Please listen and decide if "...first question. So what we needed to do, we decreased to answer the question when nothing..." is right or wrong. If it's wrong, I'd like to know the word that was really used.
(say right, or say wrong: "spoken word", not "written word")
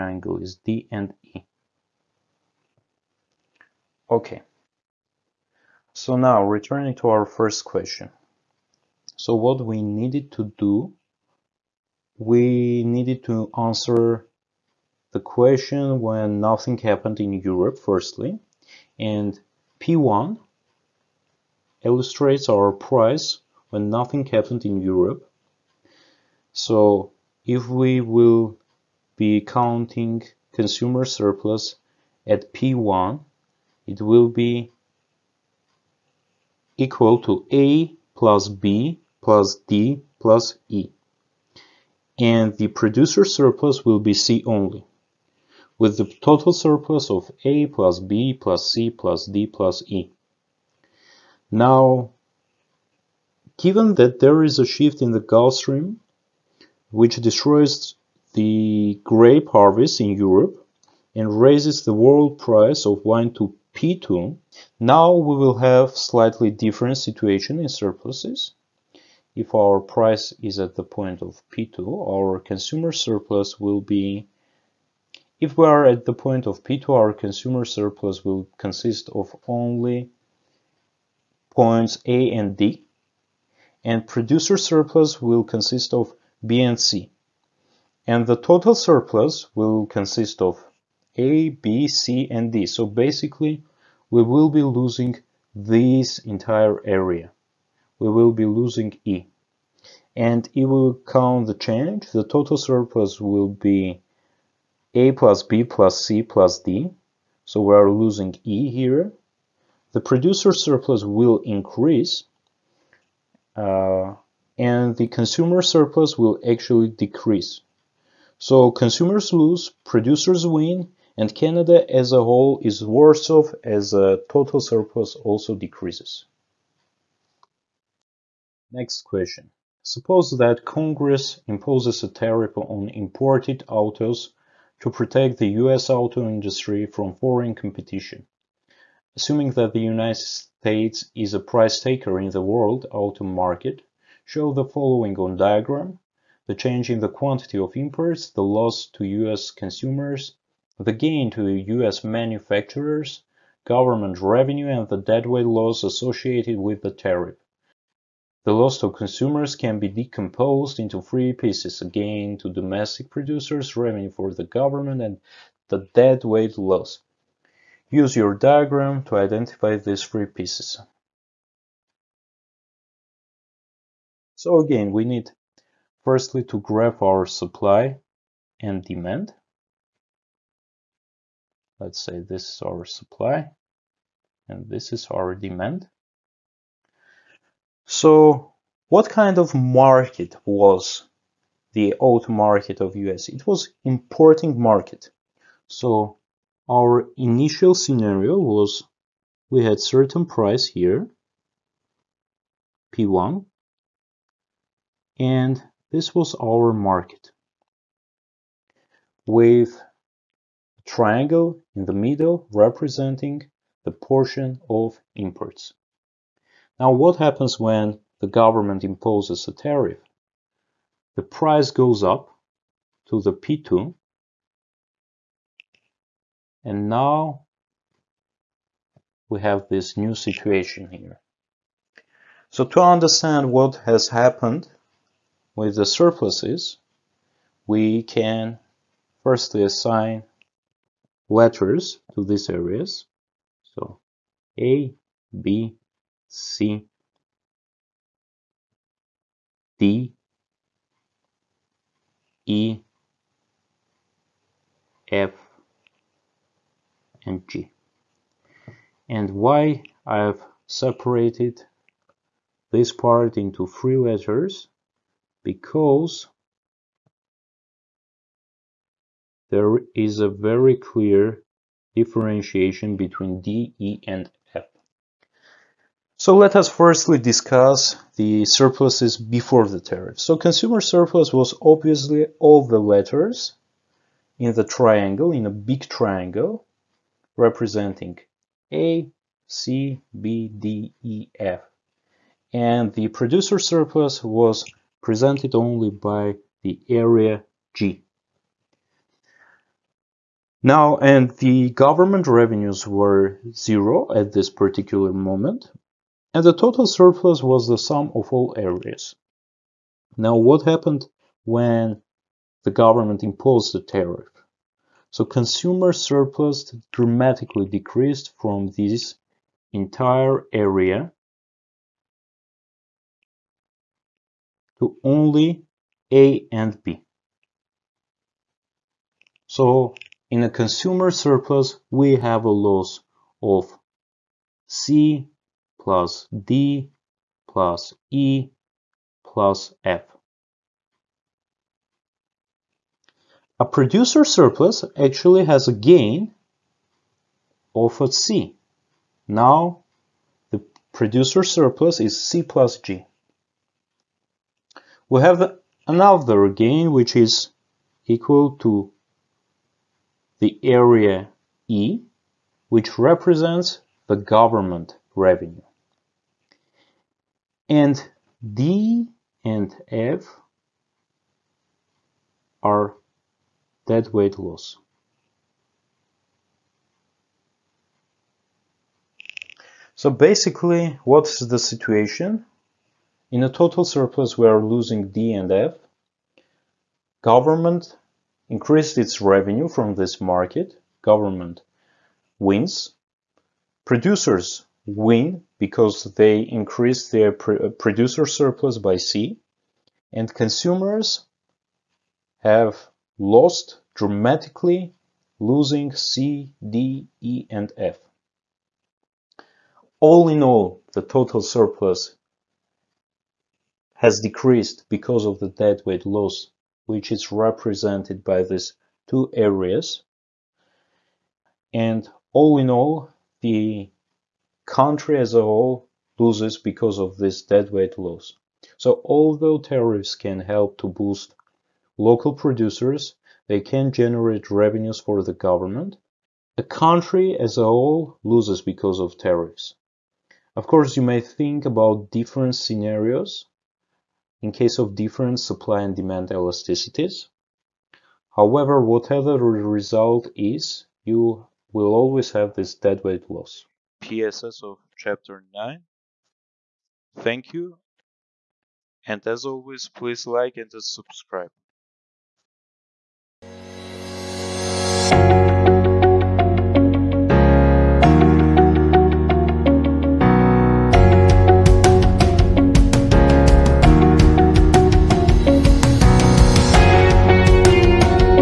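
wrong: "needed", not "decreased".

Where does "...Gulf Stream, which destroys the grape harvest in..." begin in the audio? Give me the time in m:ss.
0:55.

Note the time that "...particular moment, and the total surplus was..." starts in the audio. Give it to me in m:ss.
5:04.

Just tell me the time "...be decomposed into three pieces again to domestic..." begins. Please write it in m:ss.
2:39.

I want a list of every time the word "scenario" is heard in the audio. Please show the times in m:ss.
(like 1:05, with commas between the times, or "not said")
3:17, 7:22.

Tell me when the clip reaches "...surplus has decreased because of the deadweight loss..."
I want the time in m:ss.
6:51.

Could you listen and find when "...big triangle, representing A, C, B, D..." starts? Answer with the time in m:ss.
4:45.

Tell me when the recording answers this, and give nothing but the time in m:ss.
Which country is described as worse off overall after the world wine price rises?
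2:01.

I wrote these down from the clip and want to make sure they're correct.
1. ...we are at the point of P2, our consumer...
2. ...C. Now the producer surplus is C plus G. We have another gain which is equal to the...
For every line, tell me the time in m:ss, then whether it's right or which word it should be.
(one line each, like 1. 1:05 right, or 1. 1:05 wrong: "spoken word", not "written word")
1. 1:15 right
2. 5:48 right.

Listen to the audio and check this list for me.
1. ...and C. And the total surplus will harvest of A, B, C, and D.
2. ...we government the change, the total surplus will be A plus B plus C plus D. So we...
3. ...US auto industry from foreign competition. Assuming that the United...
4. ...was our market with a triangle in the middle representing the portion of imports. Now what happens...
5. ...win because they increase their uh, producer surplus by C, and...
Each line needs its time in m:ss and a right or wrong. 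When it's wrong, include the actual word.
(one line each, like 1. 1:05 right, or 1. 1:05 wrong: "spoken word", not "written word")
1. 1:26 wrong: "consist", not "harvest"
2. 1:40 wrong: "count", not "government"
3. 2:15 right
4. 3:26 right
5. 6:34 right.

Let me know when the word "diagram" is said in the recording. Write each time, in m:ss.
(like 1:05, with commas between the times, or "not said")
2:25, 2:48.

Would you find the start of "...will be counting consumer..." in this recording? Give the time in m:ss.
0:28.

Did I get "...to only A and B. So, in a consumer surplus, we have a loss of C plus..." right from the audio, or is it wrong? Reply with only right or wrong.
right.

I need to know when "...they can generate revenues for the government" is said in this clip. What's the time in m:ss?
7:13.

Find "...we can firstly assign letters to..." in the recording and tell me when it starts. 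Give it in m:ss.
3:57.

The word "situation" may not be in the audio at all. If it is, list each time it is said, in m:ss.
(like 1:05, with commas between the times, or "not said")
1:07, 3:50, 6:21.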